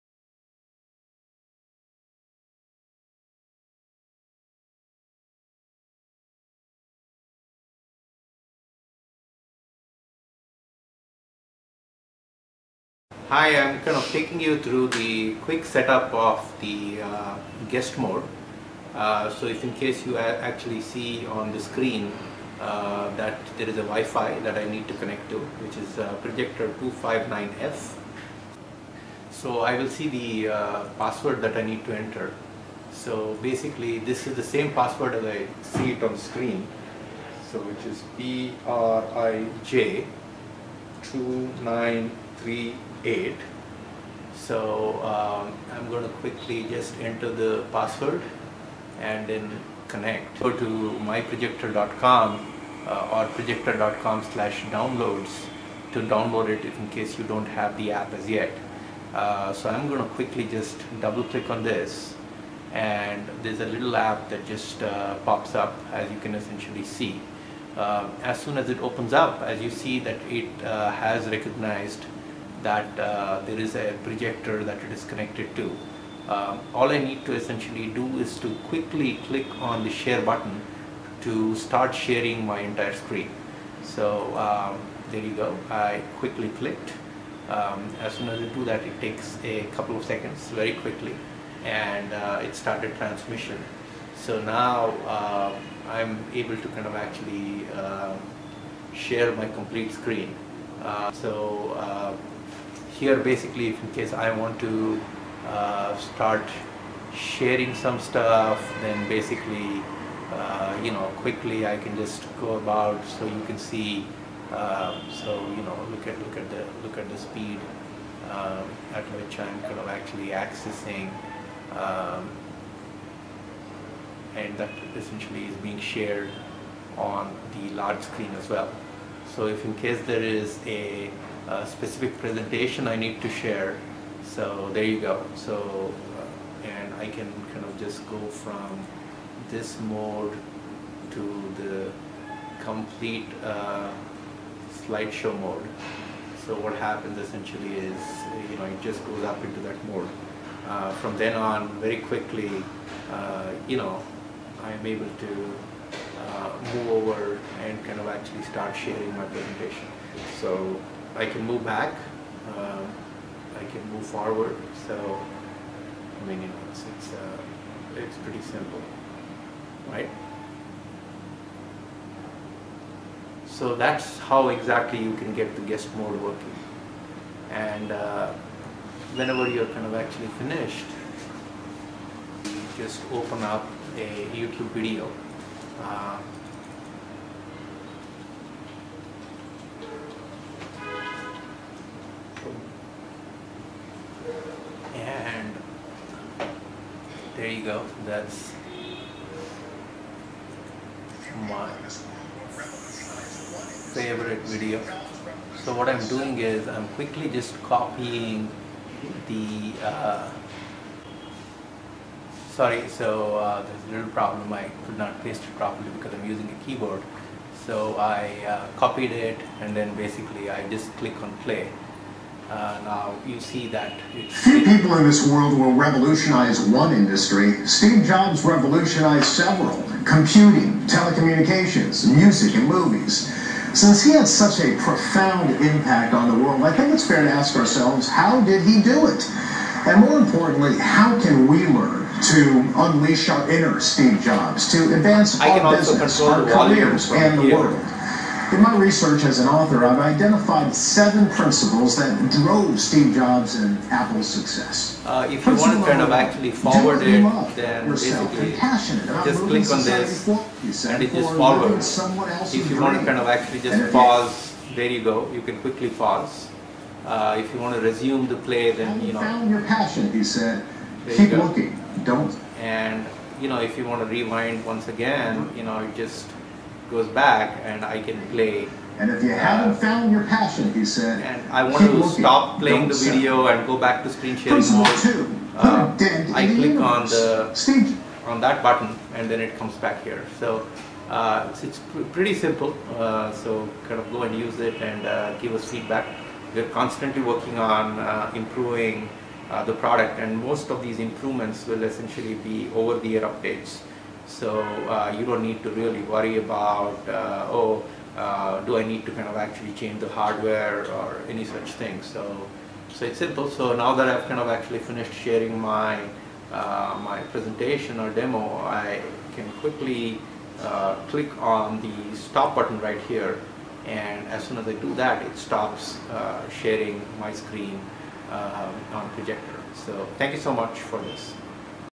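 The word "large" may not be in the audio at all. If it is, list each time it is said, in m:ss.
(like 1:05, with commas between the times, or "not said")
2:07.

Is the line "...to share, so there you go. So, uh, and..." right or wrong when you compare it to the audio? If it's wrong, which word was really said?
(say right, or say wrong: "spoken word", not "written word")
right.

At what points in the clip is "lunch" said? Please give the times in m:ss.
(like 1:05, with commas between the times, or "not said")
not said.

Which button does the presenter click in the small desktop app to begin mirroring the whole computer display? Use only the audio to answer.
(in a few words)
share button.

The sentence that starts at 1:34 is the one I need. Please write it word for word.
So now uh, I'm able to kind of actually uh, share my complete screen.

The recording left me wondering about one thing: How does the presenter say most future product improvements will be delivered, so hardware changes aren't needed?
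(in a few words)
over the air updates.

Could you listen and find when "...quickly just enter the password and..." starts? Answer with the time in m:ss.
0:46.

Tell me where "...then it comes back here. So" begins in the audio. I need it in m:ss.
4:49.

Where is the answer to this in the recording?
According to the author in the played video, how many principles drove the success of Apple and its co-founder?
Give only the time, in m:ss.
4:10.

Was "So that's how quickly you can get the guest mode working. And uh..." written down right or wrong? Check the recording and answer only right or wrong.
wrong.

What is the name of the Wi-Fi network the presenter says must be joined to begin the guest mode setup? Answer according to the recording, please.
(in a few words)
Prijector 259F.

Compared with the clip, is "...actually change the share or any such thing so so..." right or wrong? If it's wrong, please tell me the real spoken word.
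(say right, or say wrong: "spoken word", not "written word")
wrong: "hardware", not "share".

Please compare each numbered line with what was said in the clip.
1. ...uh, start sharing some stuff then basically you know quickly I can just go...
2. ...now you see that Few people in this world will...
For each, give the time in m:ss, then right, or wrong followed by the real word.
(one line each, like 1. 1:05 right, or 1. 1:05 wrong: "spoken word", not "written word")
1. 1:45 right
2. 3:42 right.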